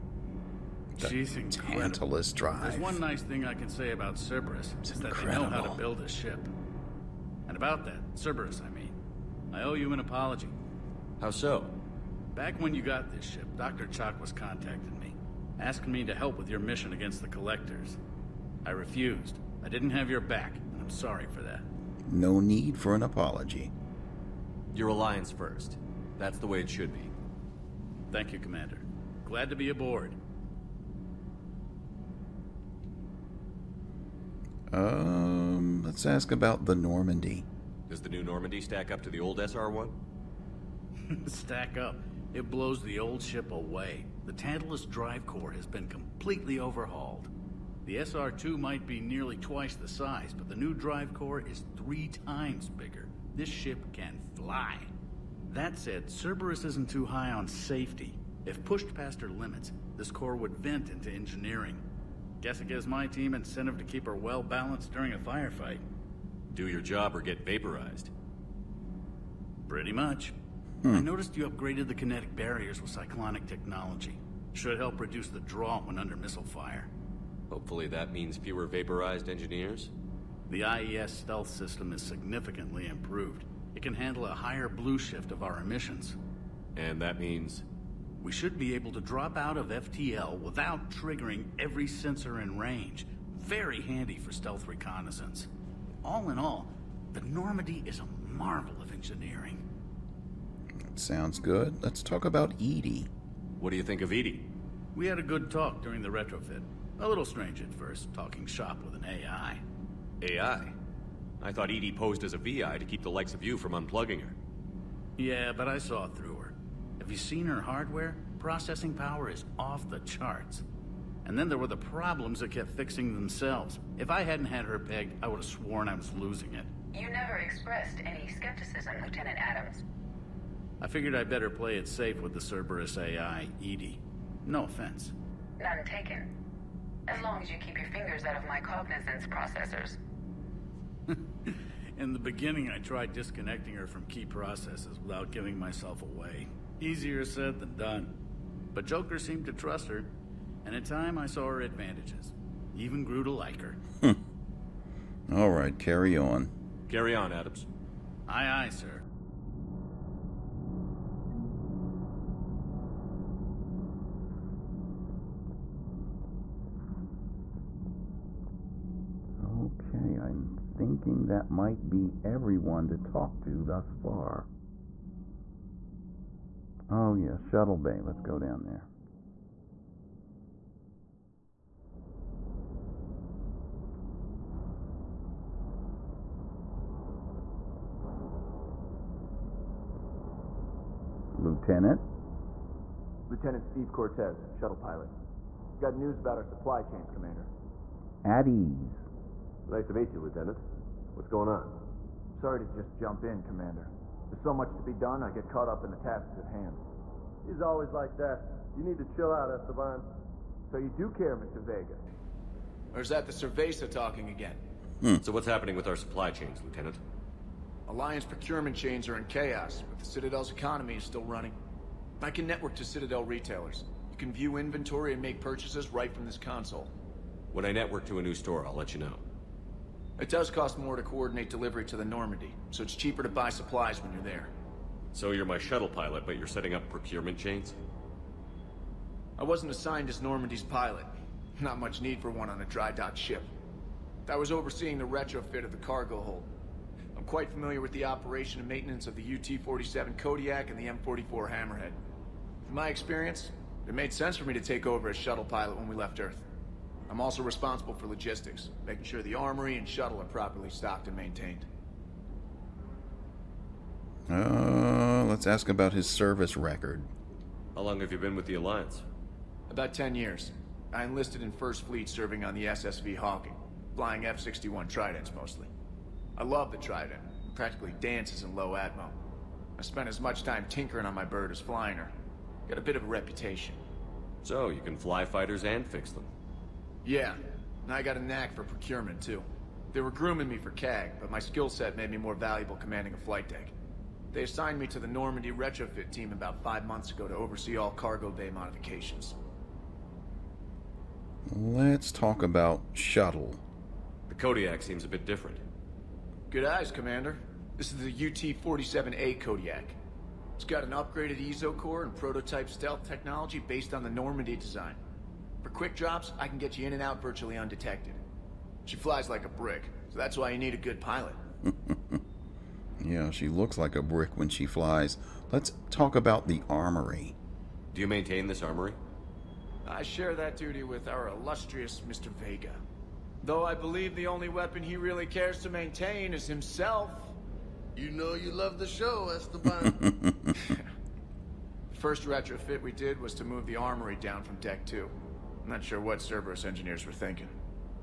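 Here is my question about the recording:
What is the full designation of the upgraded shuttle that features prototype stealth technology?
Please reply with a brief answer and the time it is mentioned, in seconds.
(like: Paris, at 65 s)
UT-47A Kodiak, at 308 s.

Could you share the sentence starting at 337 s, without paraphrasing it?
You know you love the show, Esteban.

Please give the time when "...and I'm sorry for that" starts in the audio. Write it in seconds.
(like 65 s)
20 s.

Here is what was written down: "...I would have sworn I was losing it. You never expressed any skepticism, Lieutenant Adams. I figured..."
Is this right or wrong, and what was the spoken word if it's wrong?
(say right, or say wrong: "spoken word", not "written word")
right.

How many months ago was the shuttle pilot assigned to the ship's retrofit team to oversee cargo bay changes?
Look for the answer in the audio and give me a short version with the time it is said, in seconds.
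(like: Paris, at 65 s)
5, at 296 s.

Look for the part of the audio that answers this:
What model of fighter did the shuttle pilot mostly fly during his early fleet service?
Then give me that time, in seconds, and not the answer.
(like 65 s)
274 s.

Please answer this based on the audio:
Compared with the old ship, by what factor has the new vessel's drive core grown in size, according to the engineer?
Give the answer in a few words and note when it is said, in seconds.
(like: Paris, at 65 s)
3 times, at 51 s.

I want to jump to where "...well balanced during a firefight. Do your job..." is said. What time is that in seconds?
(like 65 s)
64 s.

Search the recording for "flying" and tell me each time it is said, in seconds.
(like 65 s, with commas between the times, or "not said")
273 s, 281 s.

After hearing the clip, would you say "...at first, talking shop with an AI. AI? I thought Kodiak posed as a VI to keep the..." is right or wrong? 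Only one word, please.
wrong.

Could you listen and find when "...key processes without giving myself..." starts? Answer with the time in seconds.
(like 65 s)
144 s.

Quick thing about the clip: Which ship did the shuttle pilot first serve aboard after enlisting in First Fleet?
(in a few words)
SSV Hawking.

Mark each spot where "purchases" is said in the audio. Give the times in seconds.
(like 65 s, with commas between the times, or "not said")
225 s.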